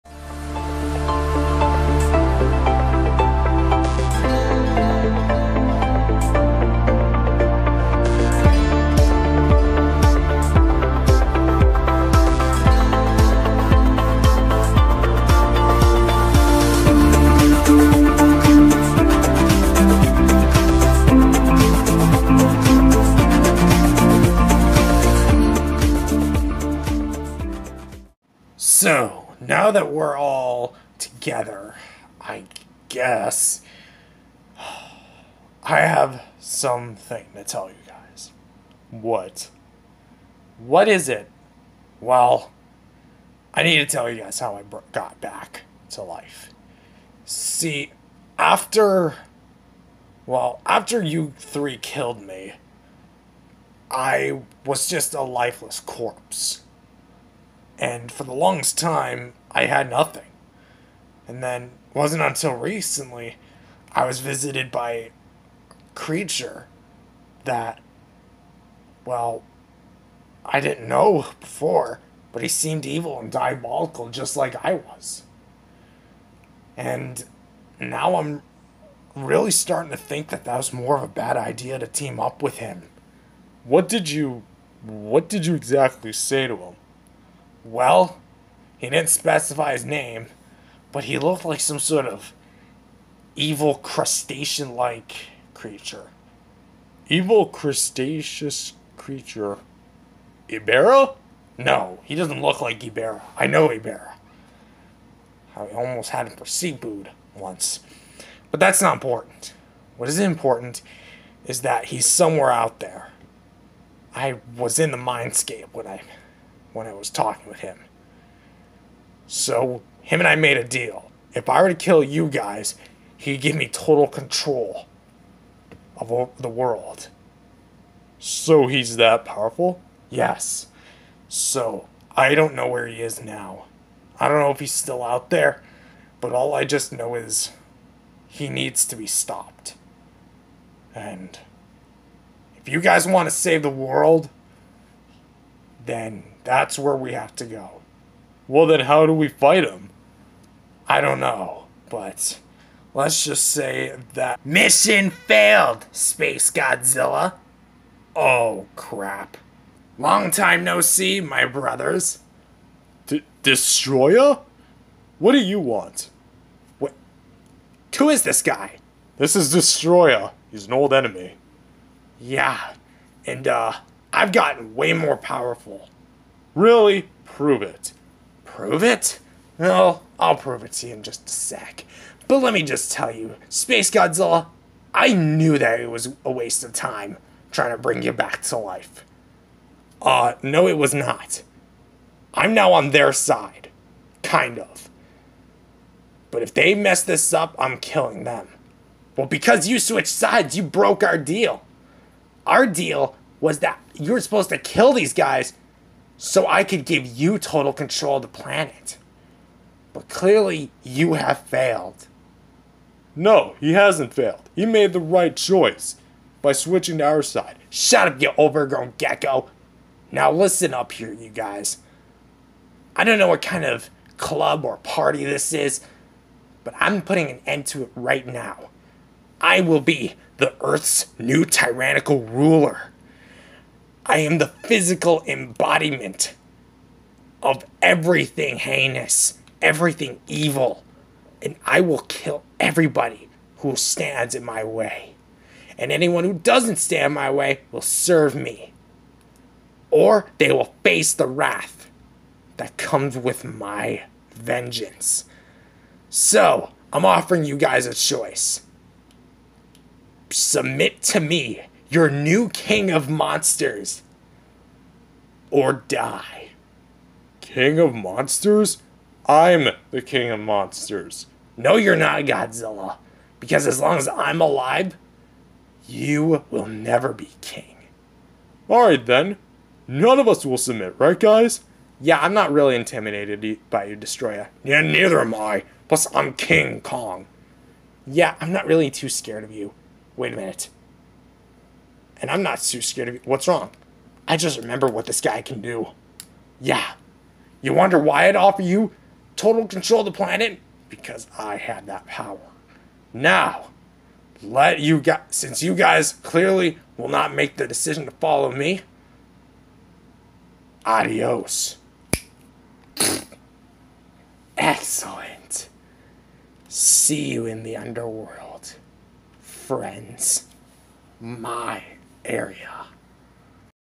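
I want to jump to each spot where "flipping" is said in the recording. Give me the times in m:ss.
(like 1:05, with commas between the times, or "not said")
not said.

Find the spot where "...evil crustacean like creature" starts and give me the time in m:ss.
1:33.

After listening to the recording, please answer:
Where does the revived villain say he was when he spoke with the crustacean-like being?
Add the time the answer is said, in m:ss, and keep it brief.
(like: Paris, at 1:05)
the mindscape, at 1:54.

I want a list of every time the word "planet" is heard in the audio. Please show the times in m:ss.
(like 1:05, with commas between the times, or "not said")
3:28, 5:00.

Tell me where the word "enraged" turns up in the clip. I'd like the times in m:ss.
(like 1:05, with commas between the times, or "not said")
not said.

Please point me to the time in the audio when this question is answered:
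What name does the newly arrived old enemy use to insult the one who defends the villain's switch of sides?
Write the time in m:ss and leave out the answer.
3:38.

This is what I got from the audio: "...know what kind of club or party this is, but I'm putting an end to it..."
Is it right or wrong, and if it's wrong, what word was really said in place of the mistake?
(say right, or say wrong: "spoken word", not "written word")
right.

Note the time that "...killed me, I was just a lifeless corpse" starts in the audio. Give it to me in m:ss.
0:51.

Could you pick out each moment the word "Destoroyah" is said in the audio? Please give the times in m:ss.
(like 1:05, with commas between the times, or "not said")
2:43, 2:49, 4:43.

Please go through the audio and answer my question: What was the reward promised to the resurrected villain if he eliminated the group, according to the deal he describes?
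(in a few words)
total control of the world.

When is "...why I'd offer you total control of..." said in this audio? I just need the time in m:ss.
4:57.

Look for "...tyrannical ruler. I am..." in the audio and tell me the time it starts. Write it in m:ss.
3:51.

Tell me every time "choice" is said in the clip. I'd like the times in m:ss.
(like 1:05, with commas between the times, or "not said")
3:35, 4:17.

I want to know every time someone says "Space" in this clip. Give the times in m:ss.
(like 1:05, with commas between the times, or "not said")
2:35, 3:03.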